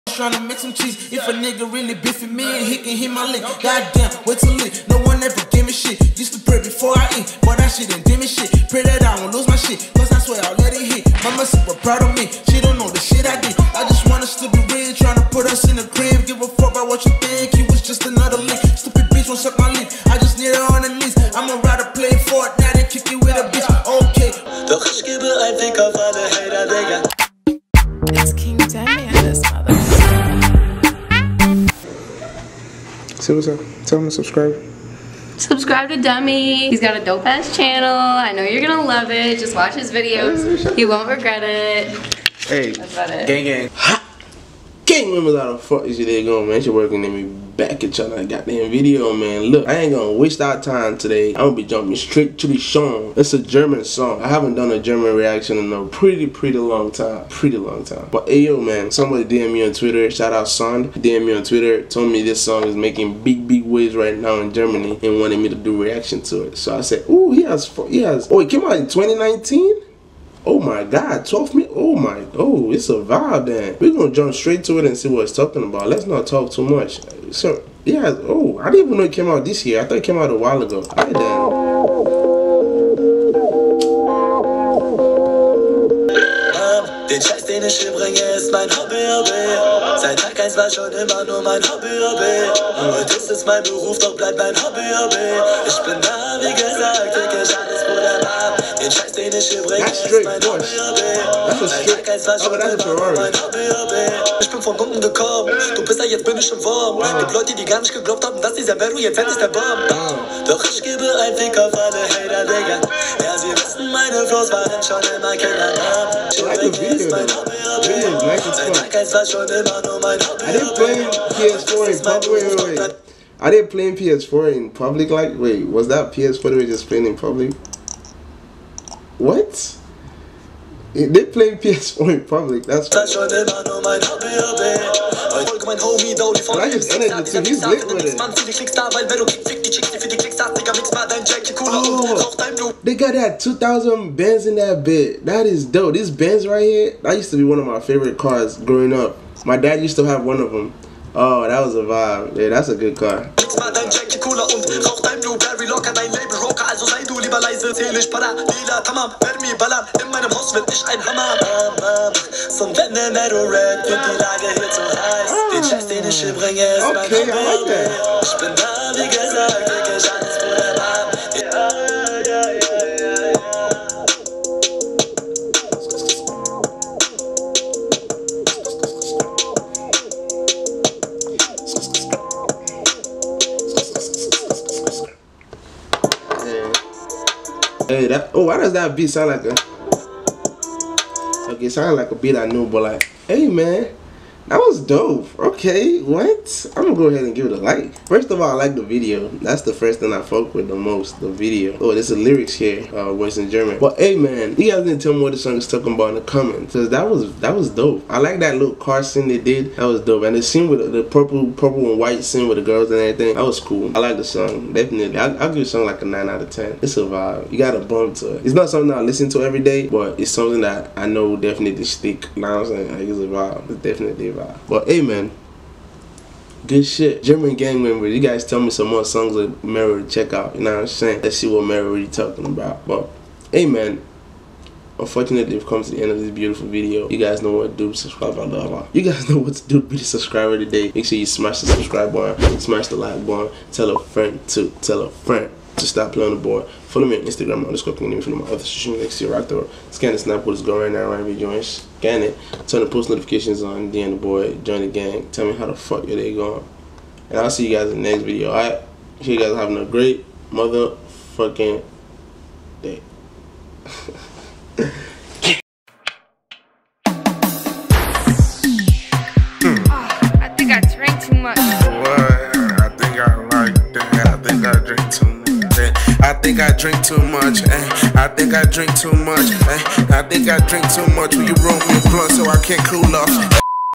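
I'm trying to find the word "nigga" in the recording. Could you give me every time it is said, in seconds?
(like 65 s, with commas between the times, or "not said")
1 s.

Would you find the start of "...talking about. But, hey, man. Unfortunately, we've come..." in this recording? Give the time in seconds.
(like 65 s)
232 s.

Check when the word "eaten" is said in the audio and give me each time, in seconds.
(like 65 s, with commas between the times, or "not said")
not said.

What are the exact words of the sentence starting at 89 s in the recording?
Seit Tag 1 war schon immer nur mein Hobby, Hobby.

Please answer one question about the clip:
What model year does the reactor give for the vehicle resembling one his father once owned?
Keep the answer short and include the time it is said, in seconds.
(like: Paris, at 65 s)
2000, at 143 s.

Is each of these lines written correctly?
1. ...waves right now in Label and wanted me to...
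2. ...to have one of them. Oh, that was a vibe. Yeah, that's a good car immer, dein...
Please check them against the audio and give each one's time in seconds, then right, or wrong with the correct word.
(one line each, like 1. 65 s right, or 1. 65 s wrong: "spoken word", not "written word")
1. 63 s wrong: "Germany", not "Label"
2. 149 s wrong: "locker", not "immer".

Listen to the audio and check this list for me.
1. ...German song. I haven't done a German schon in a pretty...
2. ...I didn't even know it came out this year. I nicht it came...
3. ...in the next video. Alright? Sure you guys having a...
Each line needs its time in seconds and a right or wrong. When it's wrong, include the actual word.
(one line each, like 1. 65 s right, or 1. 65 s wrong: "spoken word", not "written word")
1. 53 s wrong: "reaction", not "schon"
2. 78 s wrong: "thought", not "nicht"
3. 257 s right.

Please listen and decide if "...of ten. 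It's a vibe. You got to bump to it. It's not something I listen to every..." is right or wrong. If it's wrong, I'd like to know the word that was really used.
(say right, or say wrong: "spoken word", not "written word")
right.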